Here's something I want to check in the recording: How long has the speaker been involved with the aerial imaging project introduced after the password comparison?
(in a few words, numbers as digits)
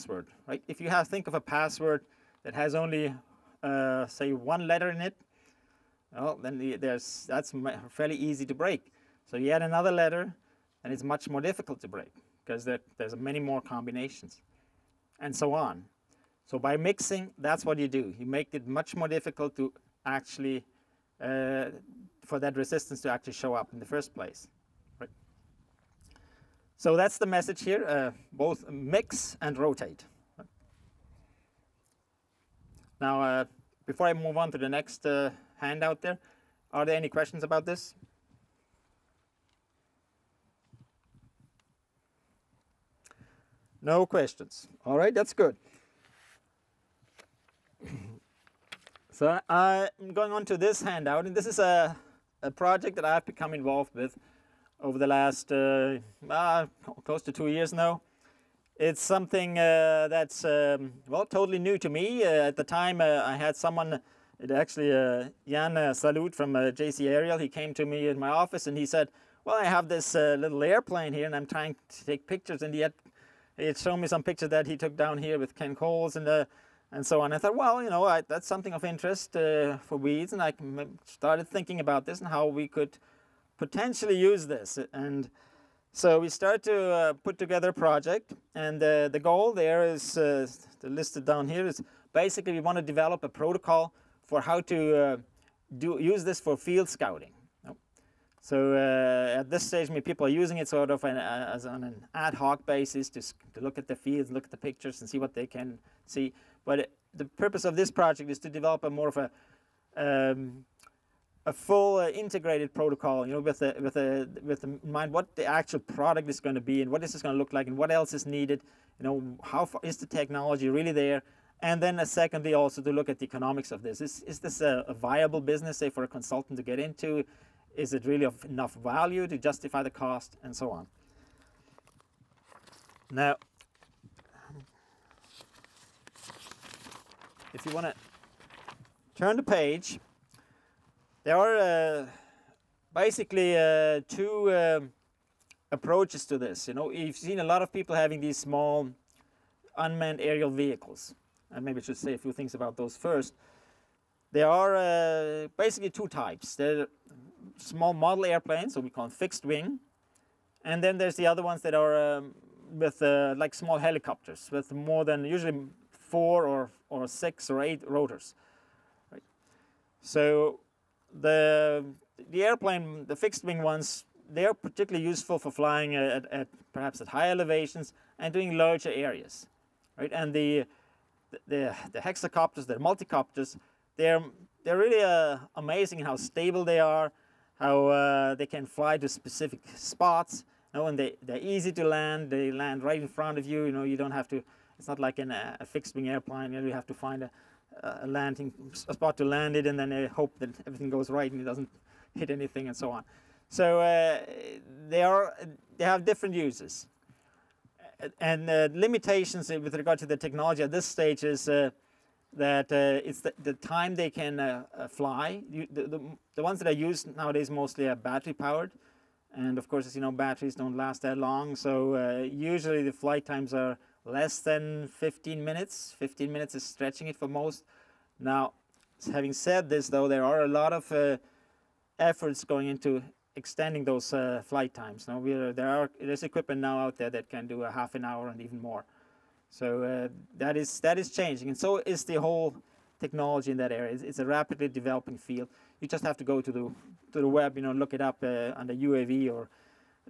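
close to 2 years.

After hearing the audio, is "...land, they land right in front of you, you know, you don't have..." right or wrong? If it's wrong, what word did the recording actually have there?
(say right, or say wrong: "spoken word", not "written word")
right.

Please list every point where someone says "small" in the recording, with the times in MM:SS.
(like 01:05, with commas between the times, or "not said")
02:28, 02:37, 02:43.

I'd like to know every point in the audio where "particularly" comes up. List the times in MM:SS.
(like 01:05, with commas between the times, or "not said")
02:54.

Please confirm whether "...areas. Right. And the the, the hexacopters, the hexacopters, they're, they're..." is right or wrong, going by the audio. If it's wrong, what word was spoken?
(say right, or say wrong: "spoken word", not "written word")
wrong: "multicopters", not "hexacopters".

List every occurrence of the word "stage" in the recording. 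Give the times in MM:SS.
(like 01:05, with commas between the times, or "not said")
01:39, 03:30.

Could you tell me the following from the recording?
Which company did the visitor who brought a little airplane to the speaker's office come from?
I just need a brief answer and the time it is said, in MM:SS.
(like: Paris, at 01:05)
JC Ariel, at 01:06.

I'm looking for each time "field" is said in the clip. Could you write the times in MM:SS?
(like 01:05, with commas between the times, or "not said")
01:36, 01:43, 04:05.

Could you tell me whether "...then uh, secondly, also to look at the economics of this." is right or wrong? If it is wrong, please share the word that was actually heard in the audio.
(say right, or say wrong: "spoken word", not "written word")
right.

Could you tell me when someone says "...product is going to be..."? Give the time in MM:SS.
01:55.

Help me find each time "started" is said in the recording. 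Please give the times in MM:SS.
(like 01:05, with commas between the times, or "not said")
01:21, 01:26.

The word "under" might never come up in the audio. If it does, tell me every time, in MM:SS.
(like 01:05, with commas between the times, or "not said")
04:08.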